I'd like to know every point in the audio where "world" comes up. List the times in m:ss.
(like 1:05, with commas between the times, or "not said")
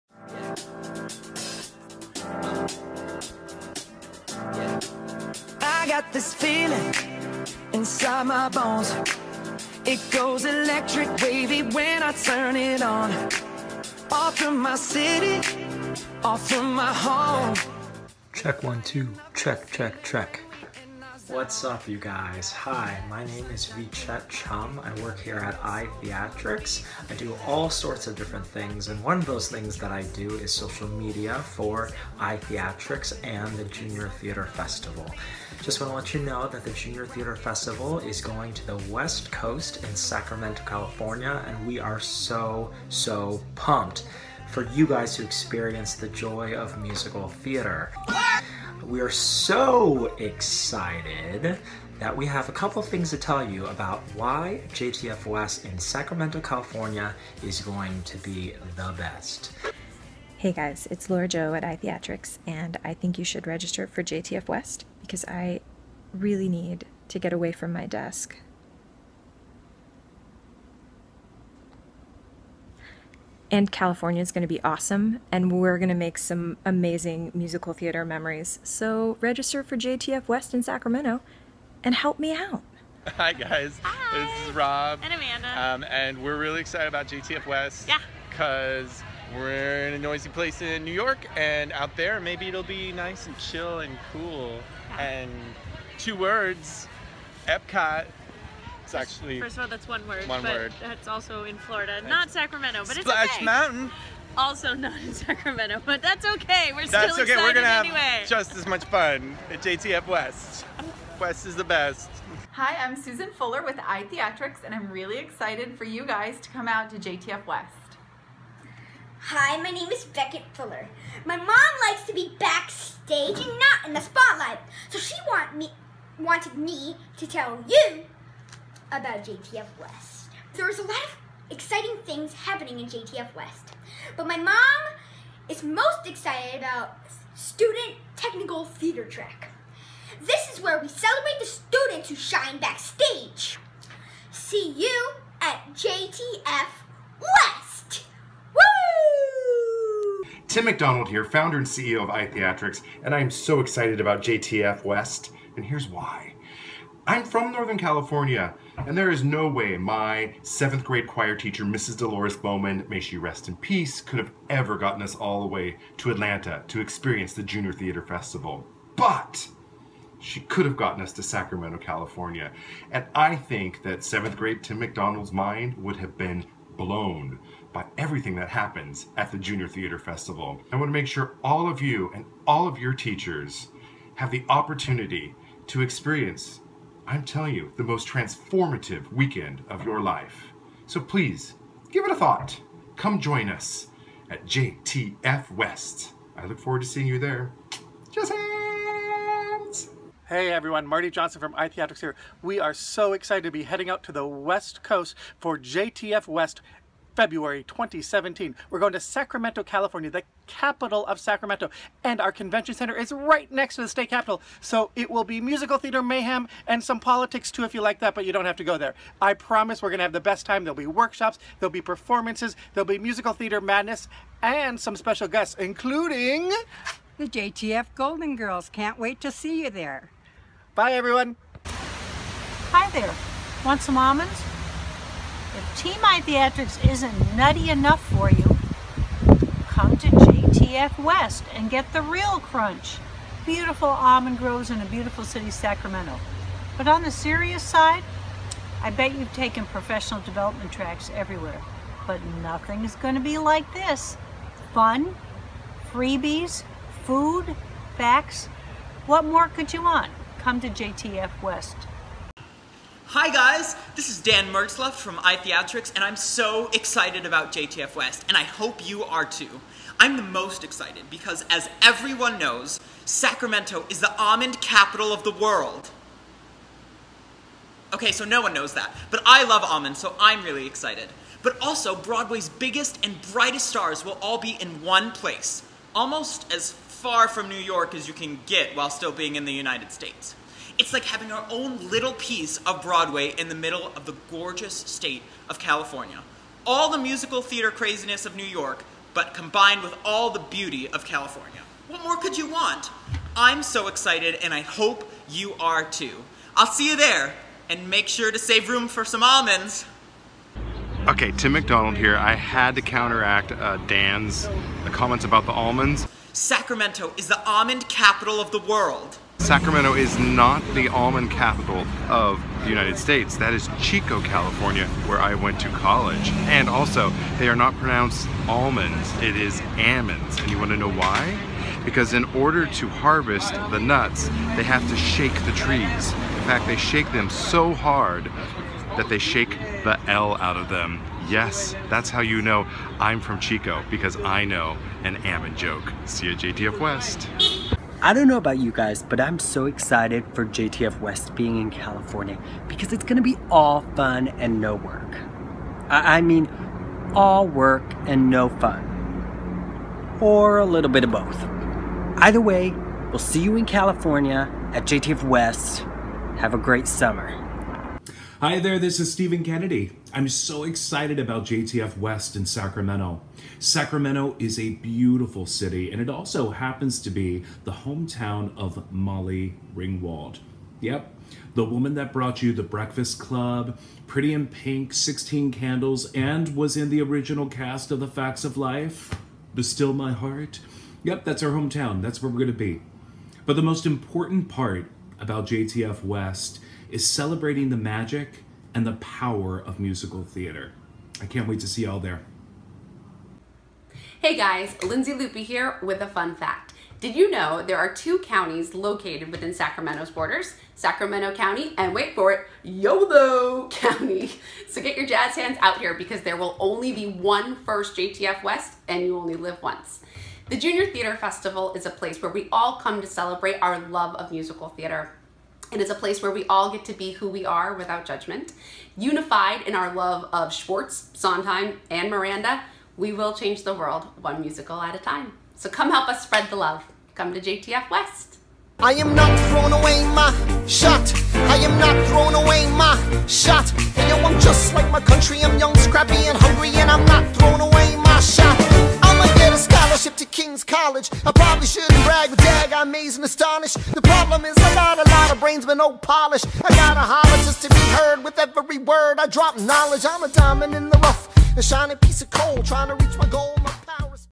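4:35, 5:18, 7:13.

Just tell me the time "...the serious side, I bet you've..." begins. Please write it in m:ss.
4:07.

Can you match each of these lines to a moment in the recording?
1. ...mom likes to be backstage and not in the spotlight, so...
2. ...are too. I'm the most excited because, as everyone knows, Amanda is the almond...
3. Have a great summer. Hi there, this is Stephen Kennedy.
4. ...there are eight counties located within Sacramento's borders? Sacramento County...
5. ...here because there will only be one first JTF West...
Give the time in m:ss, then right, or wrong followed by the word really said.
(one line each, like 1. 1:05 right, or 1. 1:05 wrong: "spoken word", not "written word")
1. 2:01 right
2. 4:29 wrong: "Sacramento", not "Amanda"
3. 6:06 right
4. 6:47 wrong: "two", not "eight"
5. 6:55 right.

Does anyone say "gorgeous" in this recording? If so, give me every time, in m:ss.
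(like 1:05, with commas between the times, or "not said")
4:54.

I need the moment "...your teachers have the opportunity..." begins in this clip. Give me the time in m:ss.
3:02.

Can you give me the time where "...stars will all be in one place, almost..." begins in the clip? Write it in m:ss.
4:43.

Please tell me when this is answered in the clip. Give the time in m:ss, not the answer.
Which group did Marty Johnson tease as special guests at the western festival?
3:47.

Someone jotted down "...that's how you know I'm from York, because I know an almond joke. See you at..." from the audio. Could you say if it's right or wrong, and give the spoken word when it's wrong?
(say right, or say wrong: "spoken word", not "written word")
wrong: "Chico", not "York".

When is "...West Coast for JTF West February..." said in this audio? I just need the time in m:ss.
3:24.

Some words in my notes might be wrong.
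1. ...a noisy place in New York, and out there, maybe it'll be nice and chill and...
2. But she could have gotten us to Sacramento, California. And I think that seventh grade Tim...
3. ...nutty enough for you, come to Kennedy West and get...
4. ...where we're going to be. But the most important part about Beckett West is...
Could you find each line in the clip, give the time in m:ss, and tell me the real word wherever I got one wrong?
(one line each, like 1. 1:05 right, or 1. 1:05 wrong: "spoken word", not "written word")
1. 1:29 right
2. 2:48 right
3. 3:57 wrong: "JTF", not "Kennedy"
4. 6:32 wrong: "JTF", not "Beckett".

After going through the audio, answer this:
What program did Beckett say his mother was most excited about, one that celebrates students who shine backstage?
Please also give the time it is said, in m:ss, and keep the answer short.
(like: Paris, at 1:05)
Student Technical Theater Track, at 2:17.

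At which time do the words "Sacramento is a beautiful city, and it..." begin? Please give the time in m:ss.
6:13.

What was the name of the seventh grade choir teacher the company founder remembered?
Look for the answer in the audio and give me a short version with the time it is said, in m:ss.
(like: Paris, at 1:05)
Dolores Bowman, at 2:41.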